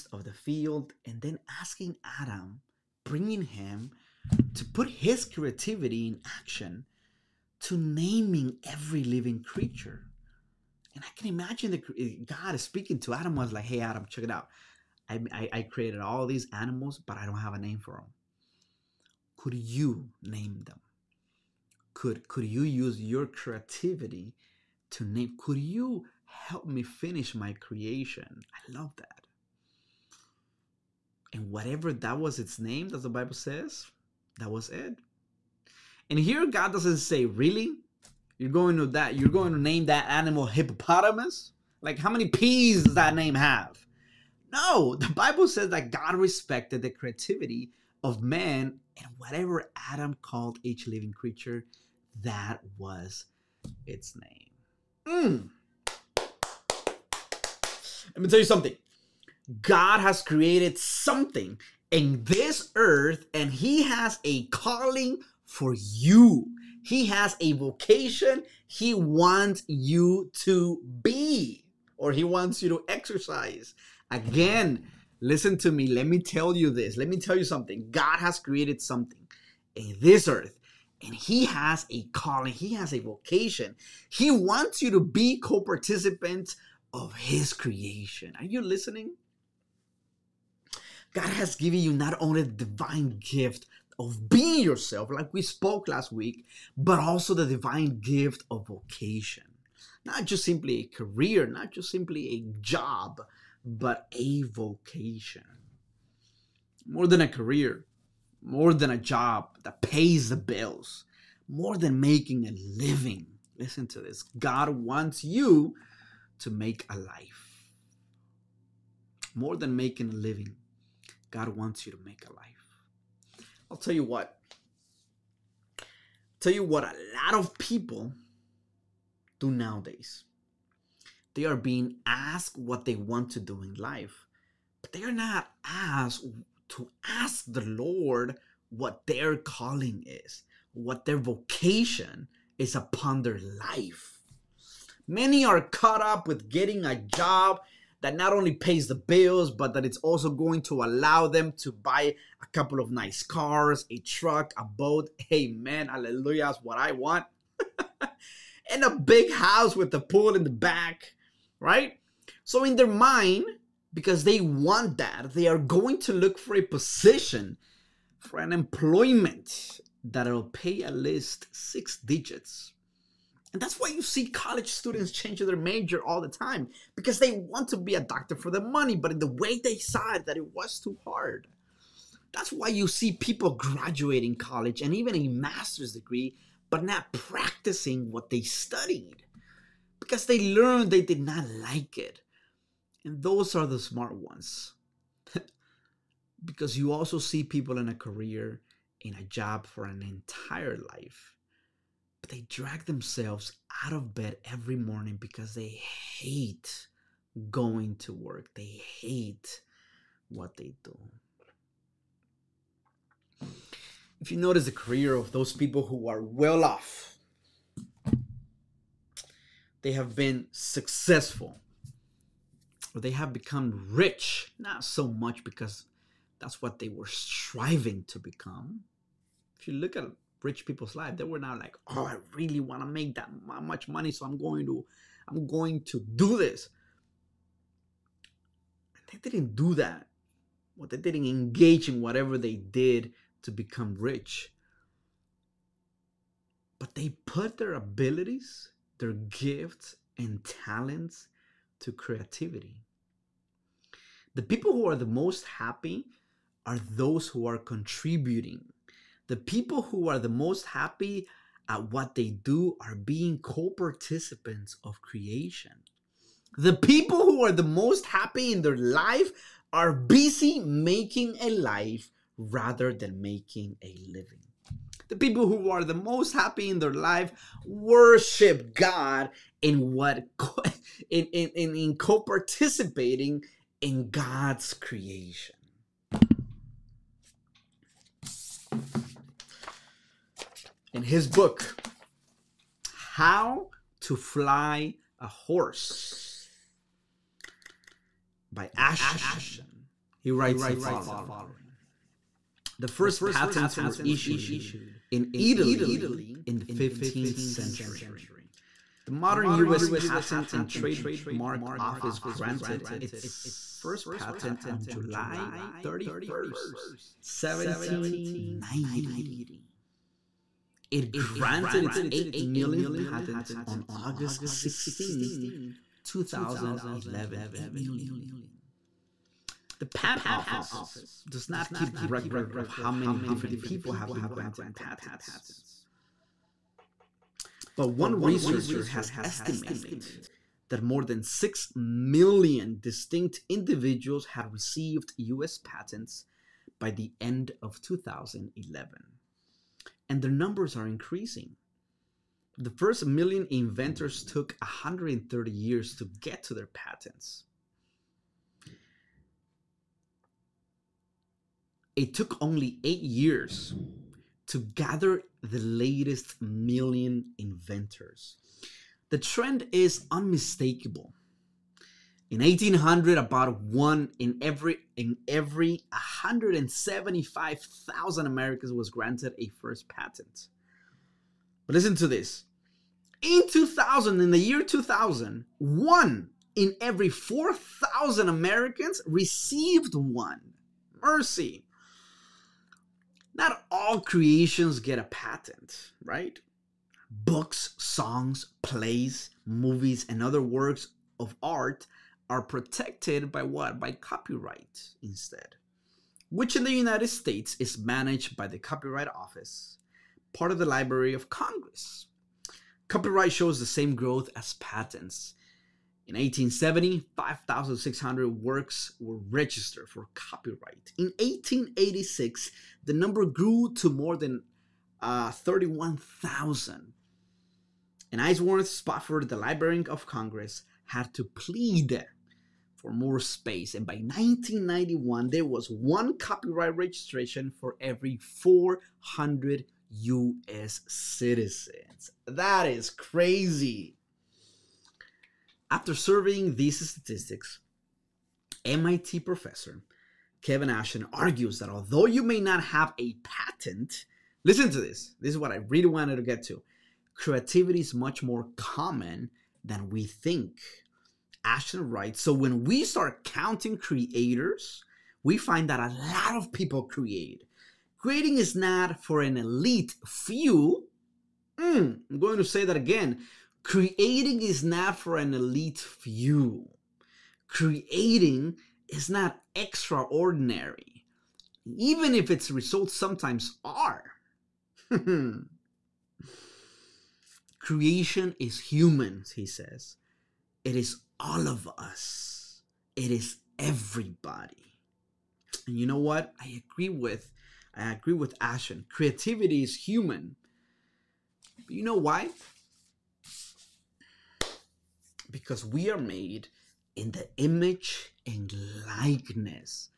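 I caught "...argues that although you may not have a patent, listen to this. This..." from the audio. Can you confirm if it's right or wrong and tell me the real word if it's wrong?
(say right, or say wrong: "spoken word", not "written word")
right.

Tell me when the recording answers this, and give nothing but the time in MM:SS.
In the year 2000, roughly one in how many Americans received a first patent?
06:27.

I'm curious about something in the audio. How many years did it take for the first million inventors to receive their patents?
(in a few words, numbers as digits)
130 years.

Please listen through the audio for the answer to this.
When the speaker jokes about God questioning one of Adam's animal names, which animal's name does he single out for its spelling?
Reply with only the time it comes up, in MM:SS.
00:40.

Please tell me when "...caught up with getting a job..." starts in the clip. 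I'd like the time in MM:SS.
02:25.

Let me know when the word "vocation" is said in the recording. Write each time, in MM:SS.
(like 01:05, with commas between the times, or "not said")
01:07, 01:22, 01:38, 01:44, 02:21.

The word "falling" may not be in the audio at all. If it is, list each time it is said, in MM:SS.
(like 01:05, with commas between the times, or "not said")
not said.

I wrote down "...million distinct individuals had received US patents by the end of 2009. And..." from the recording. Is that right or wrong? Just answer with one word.
wrong.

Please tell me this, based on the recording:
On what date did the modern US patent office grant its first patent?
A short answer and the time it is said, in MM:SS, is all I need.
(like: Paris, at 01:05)
July 31st, 1790, at 05:14.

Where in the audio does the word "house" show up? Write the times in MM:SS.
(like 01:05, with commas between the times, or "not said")
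02:39.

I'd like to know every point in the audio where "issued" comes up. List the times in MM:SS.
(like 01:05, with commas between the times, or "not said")
05:04.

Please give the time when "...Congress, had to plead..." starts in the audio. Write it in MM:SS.
07:10.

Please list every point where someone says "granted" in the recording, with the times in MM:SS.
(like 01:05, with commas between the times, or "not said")
05:12, 05:21, 05:34, 06:18.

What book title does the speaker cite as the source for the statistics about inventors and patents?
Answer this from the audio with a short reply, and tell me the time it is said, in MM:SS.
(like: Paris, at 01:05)
How to Fly a Horse, at 04:52.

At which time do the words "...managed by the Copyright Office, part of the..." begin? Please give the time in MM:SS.
06:47.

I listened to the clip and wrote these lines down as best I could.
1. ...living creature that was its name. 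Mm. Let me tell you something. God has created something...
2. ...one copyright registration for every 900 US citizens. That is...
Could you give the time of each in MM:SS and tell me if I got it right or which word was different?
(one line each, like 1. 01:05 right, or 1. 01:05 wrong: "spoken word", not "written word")
1. 00:50 right
2. 07:15 wrong: "400", not "900".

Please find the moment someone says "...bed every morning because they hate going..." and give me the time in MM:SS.
03:24.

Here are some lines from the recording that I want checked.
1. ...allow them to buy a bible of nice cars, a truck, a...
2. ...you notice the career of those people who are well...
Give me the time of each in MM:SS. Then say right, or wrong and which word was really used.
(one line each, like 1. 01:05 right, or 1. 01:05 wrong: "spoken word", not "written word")
1. 02:30 wrong: "couple", not "bible"
2. 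03:34 right.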